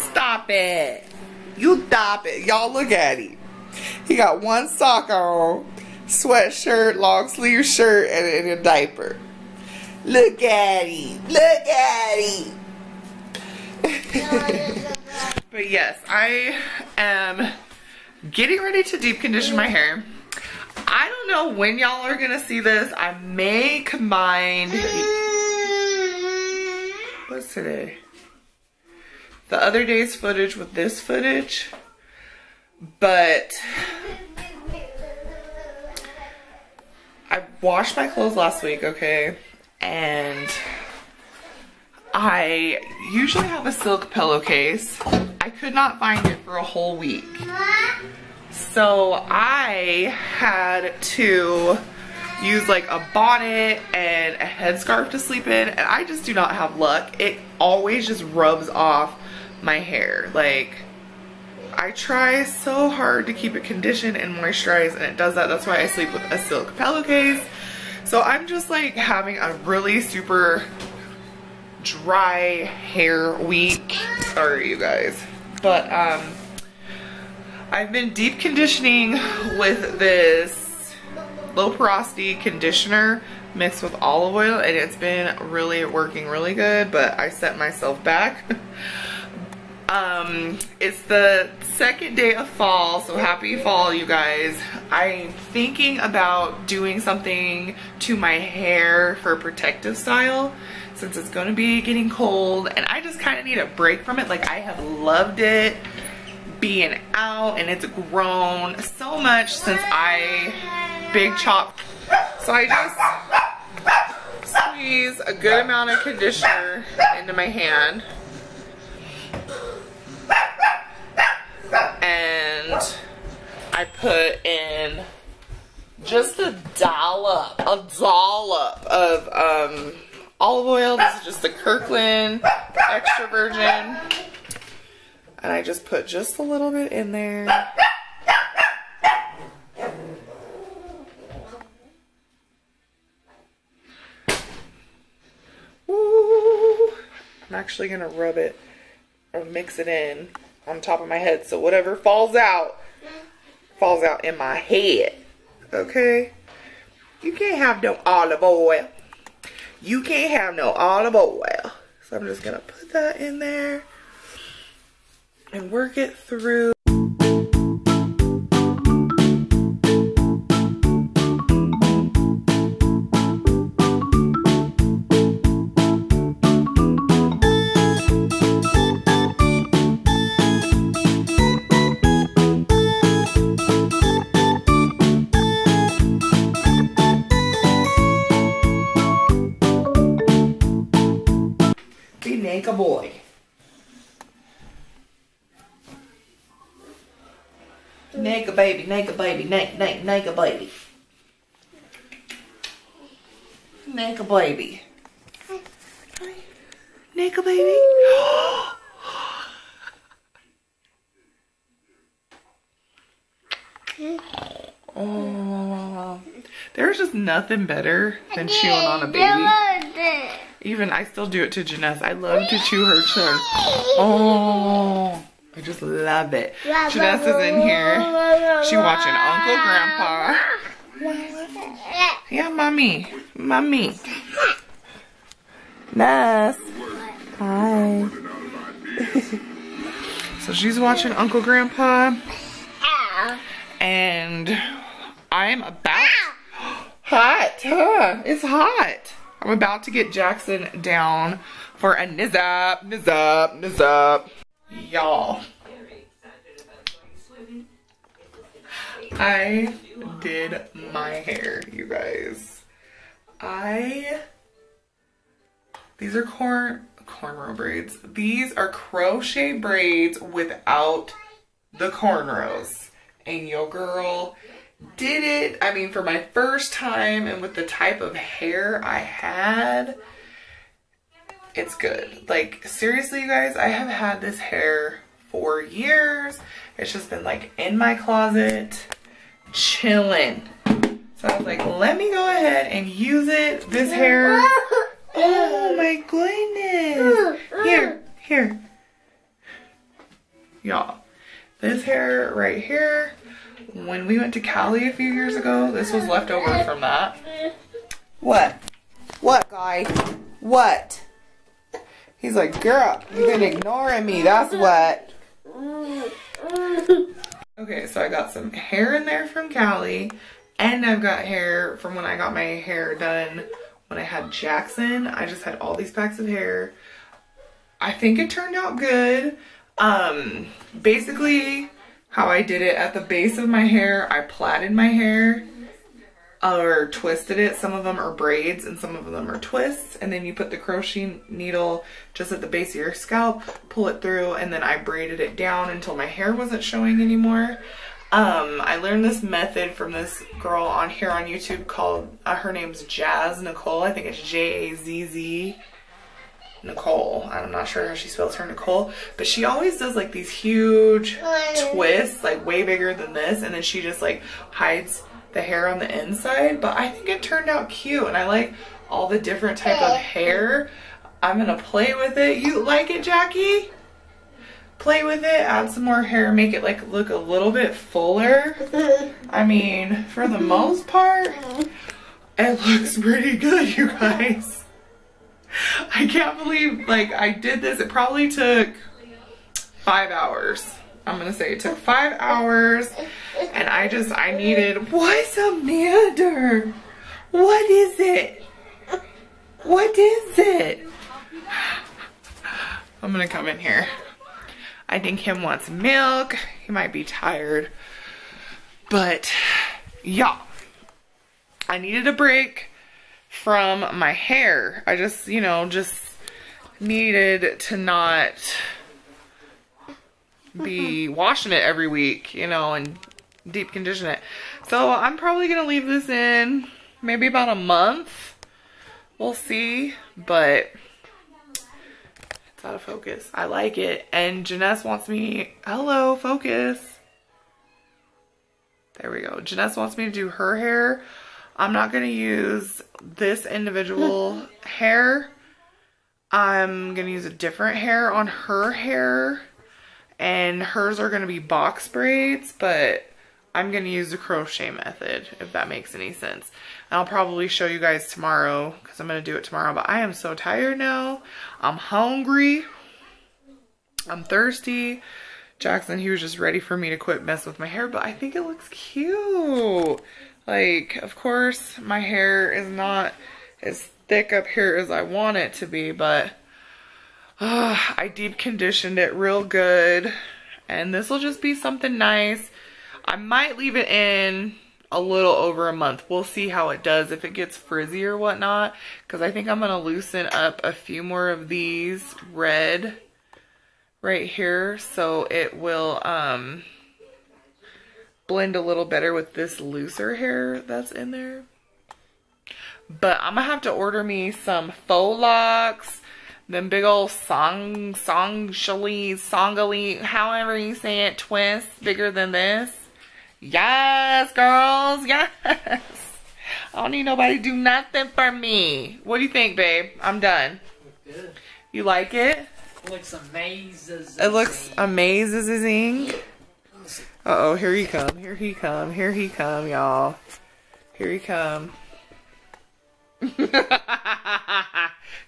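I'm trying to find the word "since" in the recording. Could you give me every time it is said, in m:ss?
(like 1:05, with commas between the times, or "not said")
1:40, 1:49.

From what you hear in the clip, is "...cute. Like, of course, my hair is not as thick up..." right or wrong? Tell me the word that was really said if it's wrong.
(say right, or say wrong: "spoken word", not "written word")
right.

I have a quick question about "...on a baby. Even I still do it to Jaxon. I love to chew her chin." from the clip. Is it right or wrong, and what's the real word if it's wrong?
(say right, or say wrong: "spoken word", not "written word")
wrong: "Janessa", not "Jaxon".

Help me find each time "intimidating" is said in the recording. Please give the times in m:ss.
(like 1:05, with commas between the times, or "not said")
not said.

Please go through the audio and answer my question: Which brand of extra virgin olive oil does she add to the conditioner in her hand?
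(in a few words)
Kirkland.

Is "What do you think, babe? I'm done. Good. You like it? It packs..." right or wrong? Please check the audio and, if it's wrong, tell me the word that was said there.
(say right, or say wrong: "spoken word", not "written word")
wrong: "looks", not "packs".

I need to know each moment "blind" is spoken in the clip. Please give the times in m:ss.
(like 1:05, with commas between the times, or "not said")
not said.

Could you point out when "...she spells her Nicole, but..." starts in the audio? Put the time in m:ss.
5:57.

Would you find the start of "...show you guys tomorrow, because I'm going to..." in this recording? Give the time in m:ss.
7:37.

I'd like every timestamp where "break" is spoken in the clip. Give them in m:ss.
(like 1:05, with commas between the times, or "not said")
1:43, 6:52.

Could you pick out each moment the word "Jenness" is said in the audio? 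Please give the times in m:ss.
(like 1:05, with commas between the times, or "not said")
7:14, 7:19.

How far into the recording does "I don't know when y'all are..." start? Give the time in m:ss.
0:20.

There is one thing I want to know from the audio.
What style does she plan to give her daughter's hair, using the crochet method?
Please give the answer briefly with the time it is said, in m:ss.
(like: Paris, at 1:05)
Box braids, at 7:31.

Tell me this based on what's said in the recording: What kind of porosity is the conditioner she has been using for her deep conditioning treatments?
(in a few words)
Low porosity.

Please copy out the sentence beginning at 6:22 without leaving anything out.
it looks pretty good, you guys.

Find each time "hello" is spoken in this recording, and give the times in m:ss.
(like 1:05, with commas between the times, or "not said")
7:15.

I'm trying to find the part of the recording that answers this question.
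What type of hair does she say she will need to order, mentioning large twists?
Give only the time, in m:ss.
8:24.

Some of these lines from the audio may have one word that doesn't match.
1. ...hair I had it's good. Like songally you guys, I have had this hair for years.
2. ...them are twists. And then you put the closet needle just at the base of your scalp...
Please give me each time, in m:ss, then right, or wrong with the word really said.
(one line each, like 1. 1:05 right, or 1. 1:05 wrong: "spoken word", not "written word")
1. 4:38 wrong: "seriously", not "songally"
2. 5:39 wrong: "crochet", not "closet".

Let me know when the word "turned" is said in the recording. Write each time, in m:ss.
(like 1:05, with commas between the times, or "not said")
5:28, 6:07.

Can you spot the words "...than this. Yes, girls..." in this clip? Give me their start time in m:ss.
8:32.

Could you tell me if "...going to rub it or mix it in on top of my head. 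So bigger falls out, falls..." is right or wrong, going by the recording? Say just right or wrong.
wrong.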